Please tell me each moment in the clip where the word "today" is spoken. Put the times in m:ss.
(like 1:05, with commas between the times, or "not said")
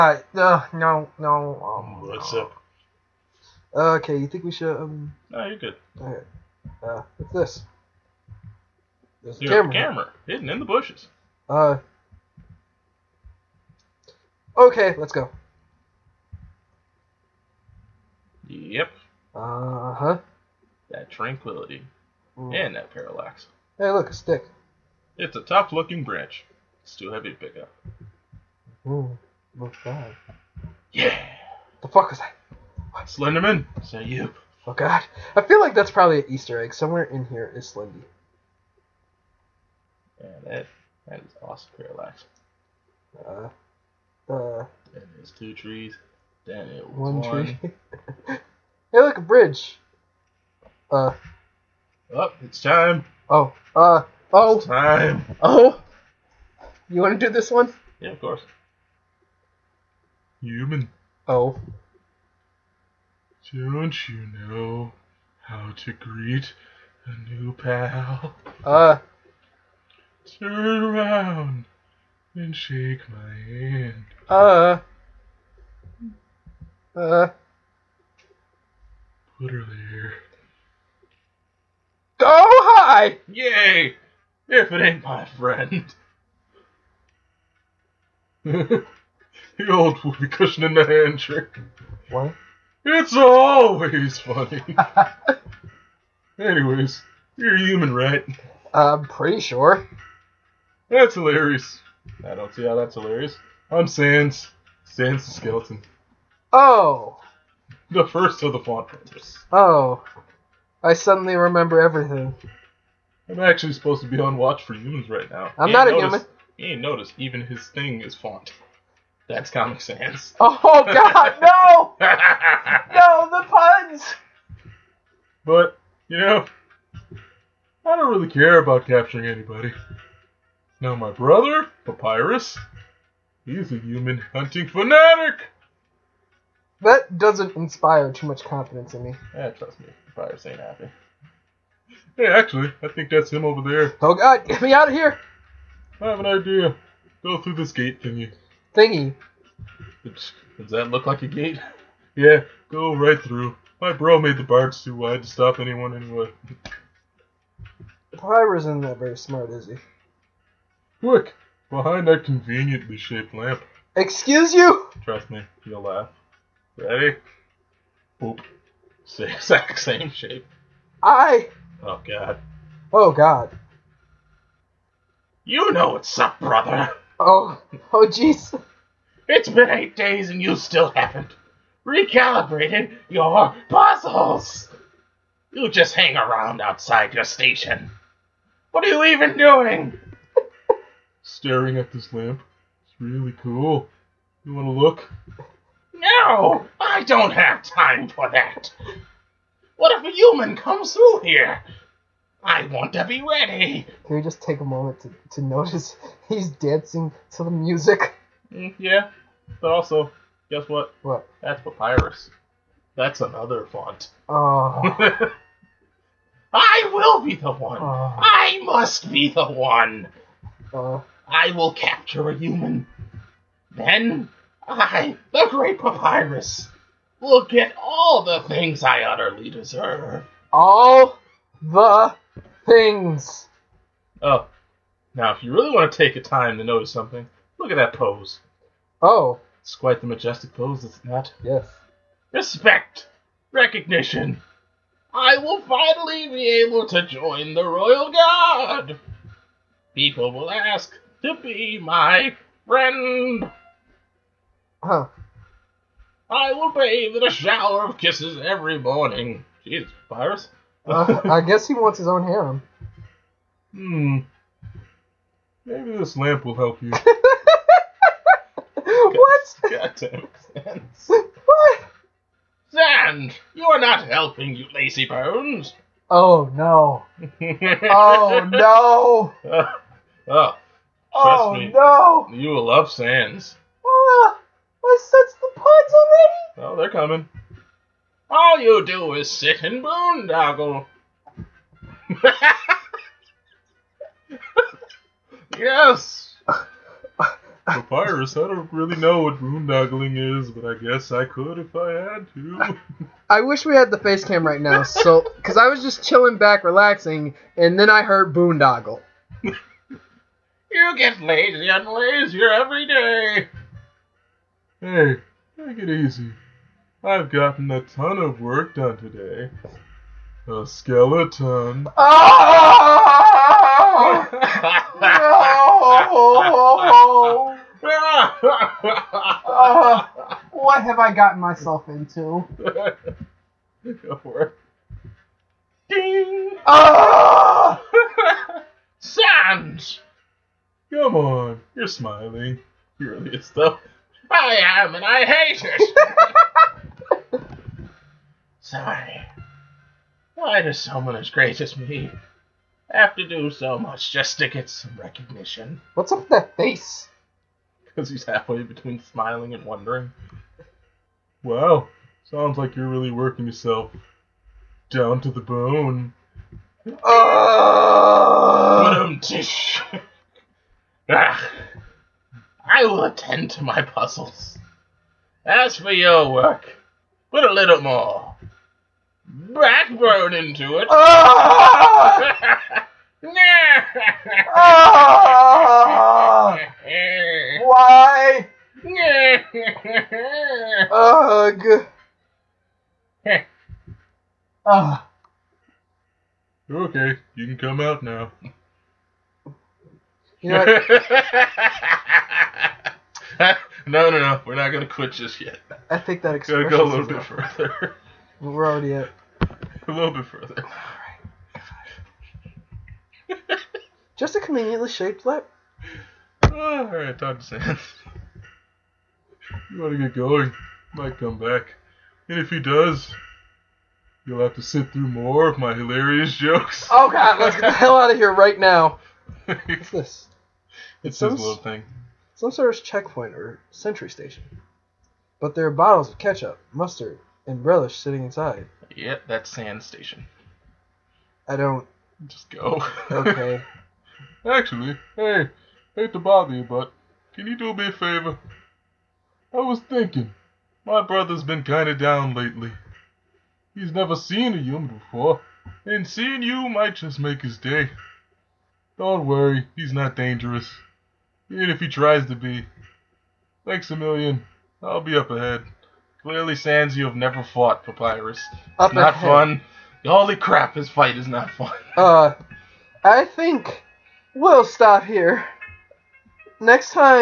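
5:18.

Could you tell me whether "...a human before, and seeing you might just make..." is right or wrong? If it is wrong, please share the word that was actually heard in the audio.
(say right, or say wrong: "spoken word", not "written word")
right.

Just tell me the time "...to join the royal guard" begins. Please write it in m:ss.
4:06.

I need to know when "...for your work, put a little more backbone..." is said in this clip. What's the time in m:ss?
6:15.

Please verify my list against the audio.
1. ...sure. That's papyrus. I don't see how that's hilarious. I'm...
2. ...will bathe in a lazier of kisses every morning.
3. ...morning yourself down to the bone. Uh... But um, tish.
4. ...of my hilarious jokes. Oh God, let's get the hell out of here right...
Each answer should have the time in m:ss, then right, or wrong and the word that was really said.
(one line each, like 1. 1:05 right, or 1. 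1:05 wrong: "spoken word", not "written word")
1. 1:39 wrong: "hilarious", not "papyrus"
2. 4:16 wrong: "shower", not "lazier"
3. 6:03 wrong: "working", not "morning"
4. 7:05 right.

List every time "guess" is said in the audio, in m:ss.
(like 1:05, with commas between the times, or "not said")
3:30, 4:21, 5:00.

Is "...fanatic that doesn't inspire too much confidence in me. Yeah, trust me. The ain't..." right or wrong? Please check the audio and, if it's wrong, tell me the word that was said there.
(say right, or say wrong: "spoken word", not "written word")
right.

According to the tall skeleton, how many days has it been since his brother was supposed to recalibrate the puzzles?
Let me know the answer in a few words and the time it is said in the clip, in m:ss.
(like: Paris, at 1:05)
8, at 2:59.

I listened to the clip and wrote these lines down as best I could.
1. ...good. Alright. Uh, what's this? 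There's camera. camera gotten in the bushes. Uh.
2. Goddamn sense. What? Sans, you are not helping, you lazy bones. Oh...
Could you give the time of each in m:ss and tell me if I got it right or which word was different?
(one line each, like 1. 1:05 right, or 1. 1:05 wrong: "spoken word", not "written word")
1. 0:05 wrong: "hidden", not "gotten"
2. 4:29 right.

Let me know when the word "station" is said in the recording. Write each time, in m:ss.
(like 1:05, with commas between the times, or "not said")
3:07, 7:14, 7:19.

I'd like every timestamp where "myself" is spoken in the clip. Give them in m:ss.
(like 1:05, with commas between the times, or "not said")
5:31.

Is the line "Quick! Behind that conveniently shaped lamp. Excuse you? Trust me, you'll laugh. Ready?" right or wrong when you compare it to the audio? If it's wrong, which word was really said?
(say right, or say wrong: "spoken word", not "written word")
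right.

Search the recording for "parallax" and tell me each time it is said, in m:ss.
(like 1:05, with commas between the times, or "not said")
0:22, 0:41.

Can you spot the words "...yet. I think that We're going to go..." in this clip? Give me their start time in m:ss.
6:45.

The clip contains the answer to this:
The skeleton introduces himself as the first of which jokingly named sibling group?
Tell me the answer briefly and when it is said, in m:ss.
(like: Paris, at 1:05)
Font Brothers, at 1:48.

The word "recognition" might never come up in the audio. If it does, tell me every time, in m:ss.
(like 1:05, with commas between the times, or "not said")
4:03, 5:54.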